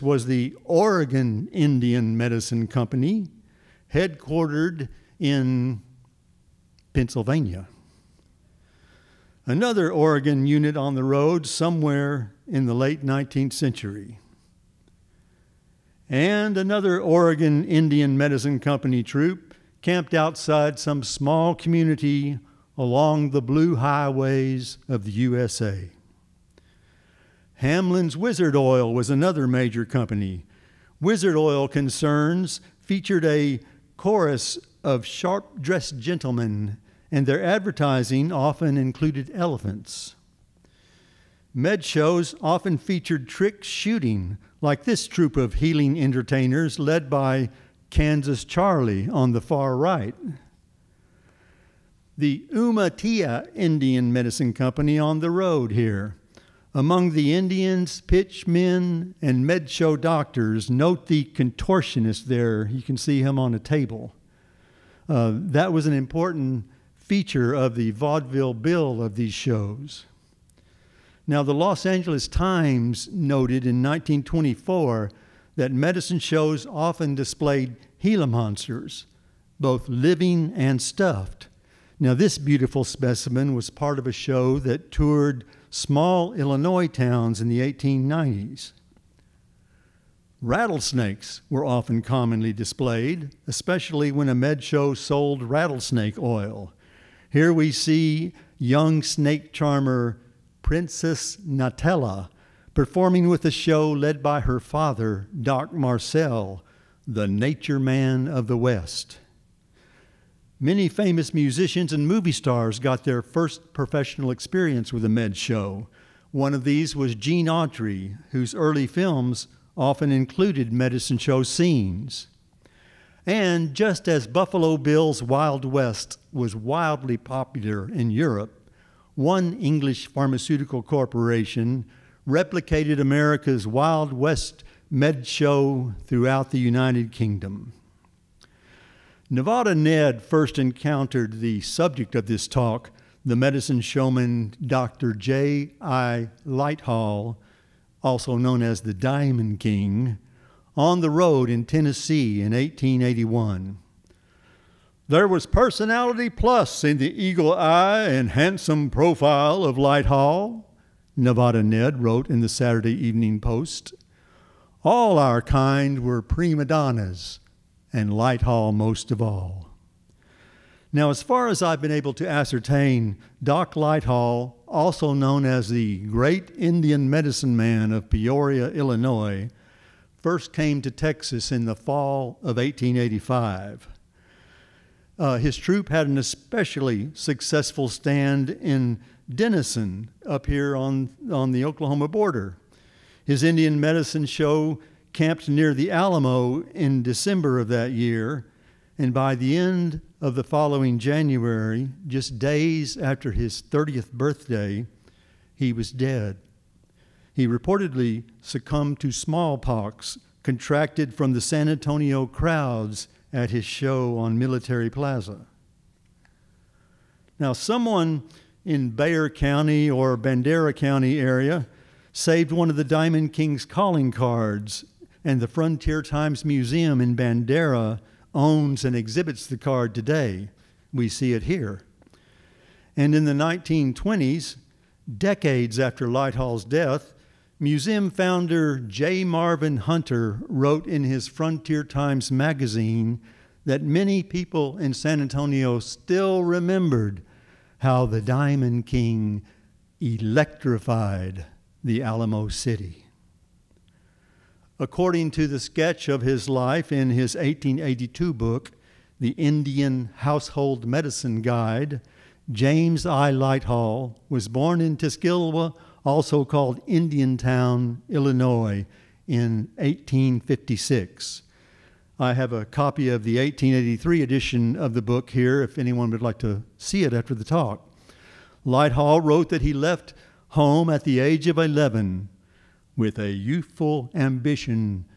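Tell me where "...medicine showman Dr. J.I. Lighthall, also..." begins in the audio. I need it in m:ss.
2:23.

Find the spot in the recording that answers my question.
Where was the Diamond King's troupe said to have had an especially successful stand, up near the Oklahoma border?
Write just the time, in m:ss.
3:09.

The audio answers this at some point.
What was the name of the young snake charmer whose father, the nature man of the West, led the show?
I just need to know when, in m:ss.
1:40.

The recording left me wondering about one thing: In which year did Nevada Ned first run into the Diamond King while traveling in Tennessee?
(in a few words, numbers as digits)
1881.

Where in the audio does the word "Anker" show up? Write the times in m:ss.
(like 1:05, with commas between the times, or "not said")
not said.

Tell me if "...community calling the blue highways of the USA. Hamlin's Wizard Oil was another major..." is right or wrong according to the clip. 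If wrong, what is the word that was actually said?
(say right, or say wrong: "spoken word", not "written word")
wrong: "along", not "calling".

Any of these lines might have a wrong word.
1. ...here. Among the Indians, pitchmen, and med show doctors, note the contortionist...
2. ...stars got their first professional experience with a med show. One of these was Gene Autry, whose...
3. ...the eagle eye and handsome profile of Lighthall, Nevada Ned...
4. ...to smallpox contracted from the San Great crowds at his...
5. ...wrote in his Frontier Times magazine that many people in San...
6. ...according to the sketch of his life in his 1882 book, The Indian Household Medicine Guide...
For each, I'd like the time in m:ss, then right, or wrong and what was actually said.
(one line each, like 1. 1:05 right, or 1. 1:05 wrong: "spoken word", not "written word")
1. 0:55 right
2. 1:52 right
3. 2:36 right
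4. 3:28 wrong: "Antonio", not "Great"
5. 4:00 right
6. 4:14 right.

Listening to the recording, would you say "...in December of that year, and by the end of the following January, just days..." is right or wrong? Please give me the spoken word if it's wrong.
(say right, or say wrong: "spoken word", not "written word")
right.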